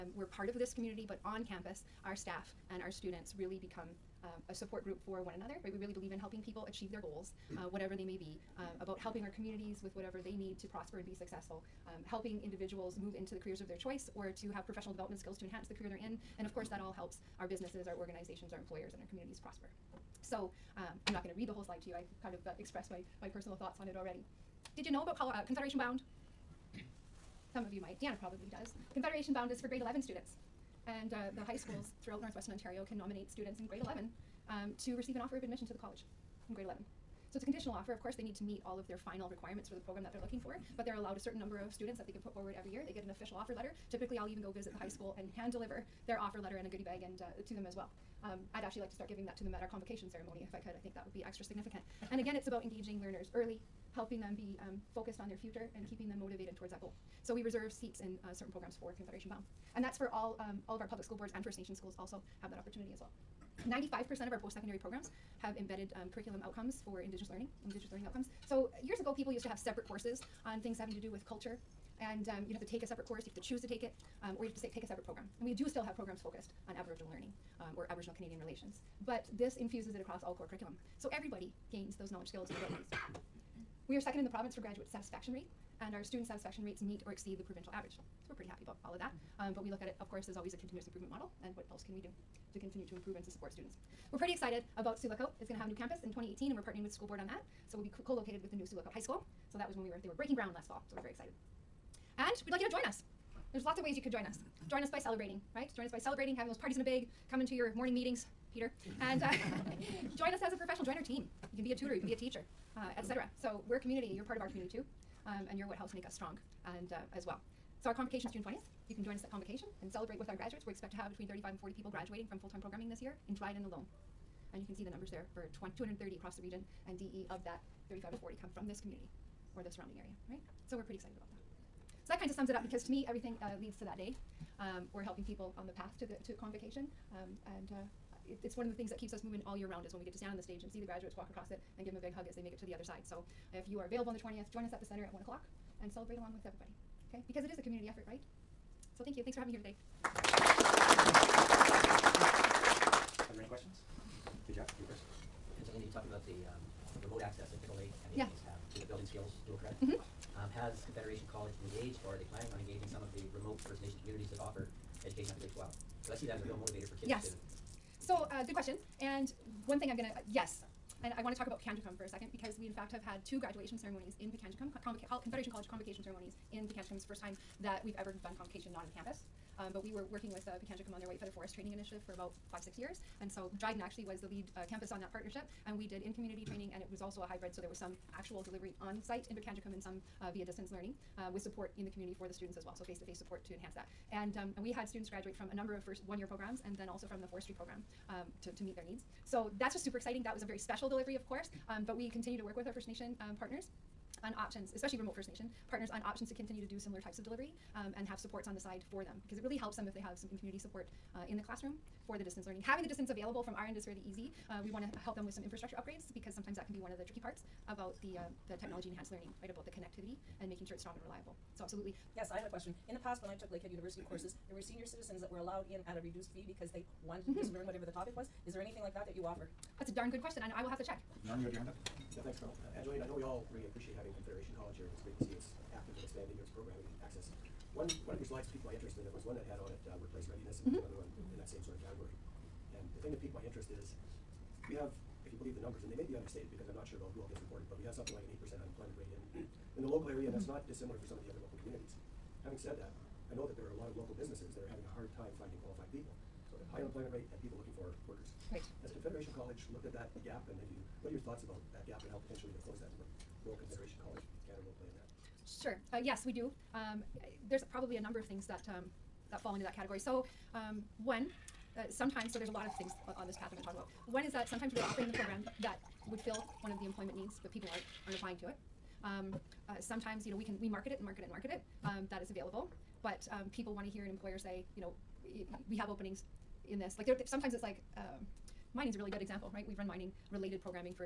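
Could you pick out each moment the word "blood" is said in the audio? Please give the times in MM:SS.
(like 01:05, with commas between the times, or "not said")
not said.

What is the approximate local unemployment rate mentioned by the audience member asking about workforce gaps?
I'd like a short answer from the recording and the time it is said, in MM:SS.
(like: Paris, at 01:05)
8%, at 04:08.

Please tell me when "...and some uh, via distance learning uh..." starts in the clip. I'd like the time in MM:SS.
03:09.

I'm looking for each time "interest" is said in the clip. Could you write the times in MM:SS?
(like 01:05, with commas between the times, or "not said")
03:58, 04:03.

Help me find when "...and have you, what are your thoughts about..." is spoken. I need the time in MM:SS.
04:20.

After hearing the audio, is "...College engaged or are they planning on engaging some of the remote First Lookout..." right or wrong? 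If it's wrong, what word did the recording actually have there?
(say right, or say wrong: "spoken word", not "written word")
wrong: "Nation", not "Lookout".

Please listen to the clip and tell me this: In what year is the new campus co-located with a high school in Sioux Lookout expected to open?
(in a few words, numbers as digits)
2018.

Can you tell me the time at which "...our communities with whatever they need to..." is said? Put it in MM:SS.
00:09.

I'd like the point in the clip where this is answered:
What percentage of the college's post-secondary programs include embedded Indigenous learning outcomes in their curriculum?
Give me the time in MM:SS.
01:03.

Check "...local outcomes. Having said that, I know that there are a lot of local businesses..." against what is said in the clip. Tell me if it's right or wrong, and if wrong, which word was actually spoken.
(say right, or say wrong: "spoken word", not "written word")
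wrong: "communities", not "outcomes".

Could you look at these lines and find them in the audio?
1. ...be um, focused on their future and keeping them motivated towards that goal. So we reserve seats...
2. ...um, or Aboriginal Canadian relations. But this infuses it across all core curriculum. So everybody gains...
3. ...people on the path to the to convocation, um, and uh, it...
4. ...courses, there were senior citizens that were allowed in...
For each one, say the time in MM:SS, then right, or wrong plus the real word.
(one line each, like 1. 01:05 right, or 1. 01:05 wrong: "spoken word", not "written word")
1. 00:54 right
2. 01:17 right
3. 02:15 right
4. 03:44 right.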